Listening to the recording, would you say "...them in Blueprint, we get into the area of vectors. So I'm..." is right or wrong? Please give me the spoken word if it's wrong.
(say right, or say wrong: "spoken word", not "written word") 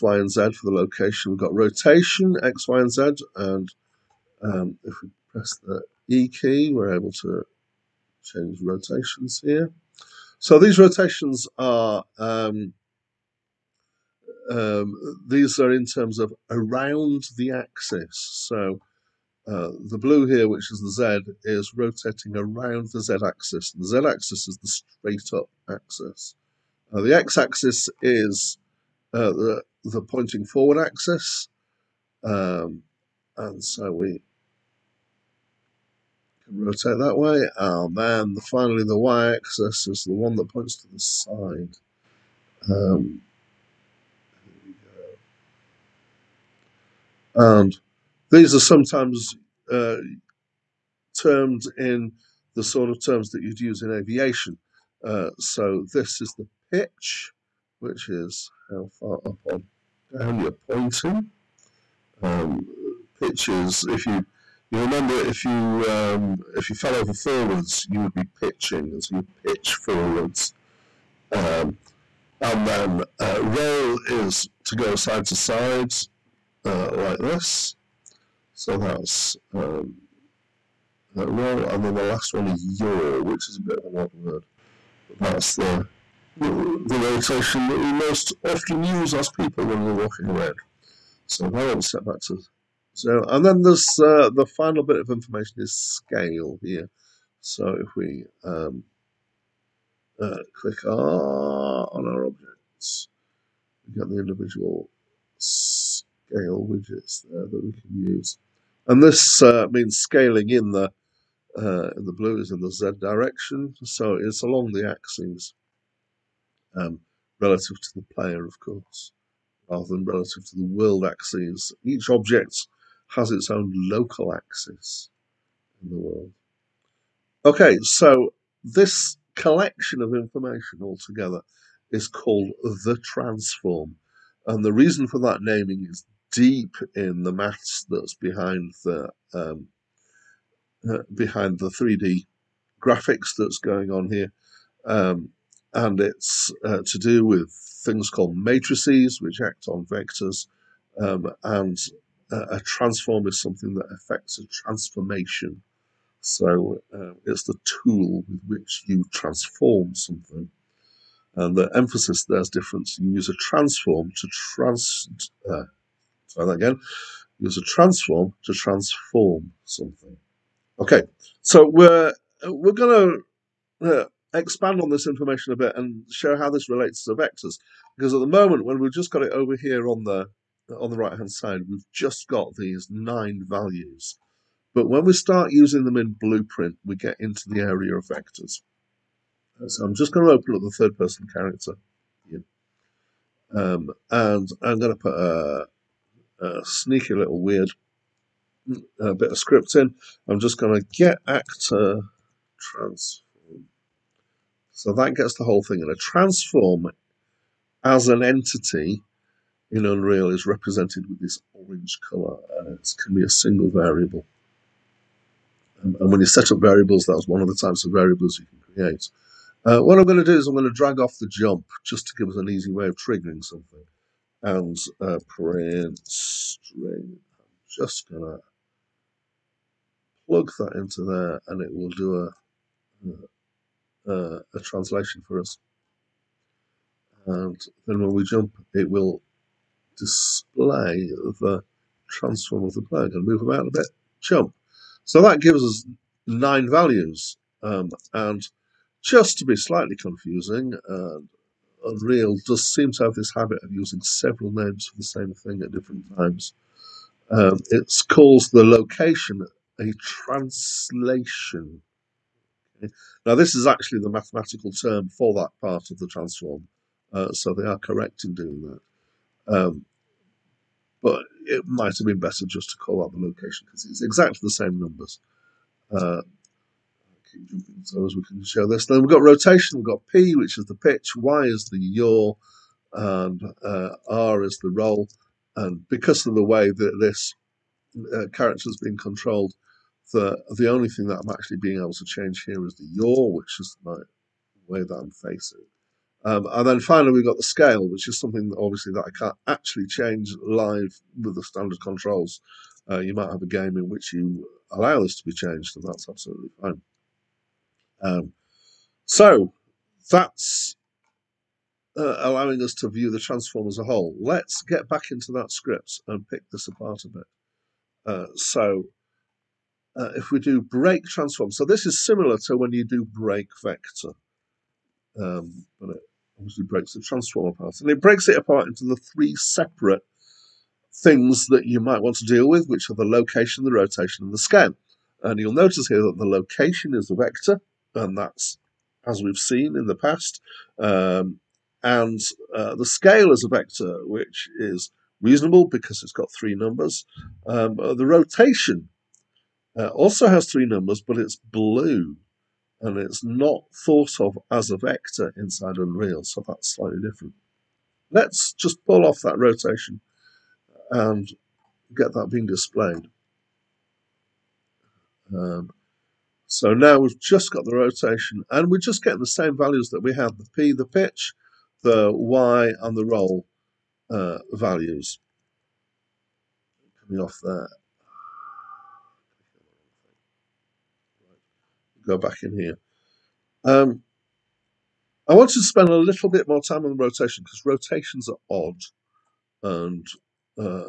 right.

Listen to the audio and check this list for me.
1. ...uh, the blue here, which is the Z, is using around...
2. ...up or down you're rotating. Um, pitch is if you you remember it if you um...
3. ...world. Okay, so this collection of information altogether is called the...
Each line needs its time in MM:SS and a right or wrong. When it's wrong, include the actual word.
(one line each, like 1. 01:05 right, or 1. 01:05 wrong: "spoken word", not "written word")
1. 00:19 wrong: "rotating", not "using"
2. 00:59 wrong: "pointing", not "rotating"
3. 02:05 right.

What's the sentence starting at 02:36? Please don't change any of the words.
So uh, it's the tool with which you transform something.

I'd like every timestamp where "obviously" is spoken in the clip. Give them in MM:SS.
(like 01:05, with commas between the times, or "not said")
04:58, 05:26.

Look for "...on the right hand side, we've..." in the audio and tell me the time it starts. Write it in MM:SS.
03:00.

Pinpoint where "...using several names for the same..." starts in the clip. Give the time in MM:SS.
04:13.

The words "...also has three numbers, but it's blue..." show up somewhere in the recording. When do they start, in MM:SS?
05:49.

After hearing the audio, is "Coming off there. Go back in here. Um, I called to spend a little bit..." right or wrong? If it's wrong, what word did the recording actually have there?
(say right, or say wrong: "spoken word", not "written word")
wrong: "wanted", not "called".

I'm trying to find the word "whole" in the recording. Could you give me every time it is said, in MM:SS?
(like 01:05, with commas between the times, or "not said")
03:25, 05:13.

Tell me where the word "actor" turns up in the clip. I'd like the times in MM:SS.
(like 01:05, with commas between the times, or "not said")
03:21.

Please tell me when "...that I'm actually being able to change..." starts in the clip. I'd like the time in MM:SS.
04:51.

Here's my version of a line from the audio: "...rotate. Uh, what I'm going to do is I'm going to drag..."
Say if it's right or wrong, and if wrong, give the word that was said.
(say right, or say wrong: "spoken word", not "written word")
wrong: "create", not "rotate".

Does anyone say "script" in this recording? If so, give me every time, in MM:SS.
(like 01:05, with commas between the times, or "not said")
03:19, 05:15.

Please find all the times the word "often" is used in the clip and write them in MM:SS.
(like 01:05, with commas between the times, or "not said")
01:28.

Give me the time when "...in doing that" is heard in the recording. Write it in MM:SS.
04:28.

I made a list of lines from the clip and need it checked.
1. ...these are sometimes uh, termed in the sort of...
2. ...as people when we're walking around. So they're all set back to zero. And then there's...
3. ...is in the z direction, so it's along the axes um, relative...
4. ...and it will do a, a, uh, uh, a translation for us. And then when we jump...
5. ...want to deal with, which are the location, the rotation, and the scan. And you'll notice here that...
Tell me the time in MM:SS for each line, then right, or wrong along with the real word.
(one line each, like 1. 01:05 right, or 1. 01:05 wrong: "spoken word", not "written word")
1. 00:48 right
2. 01:29 right
3. 01:52 right
4. 03:51 right
5. 05:32 right.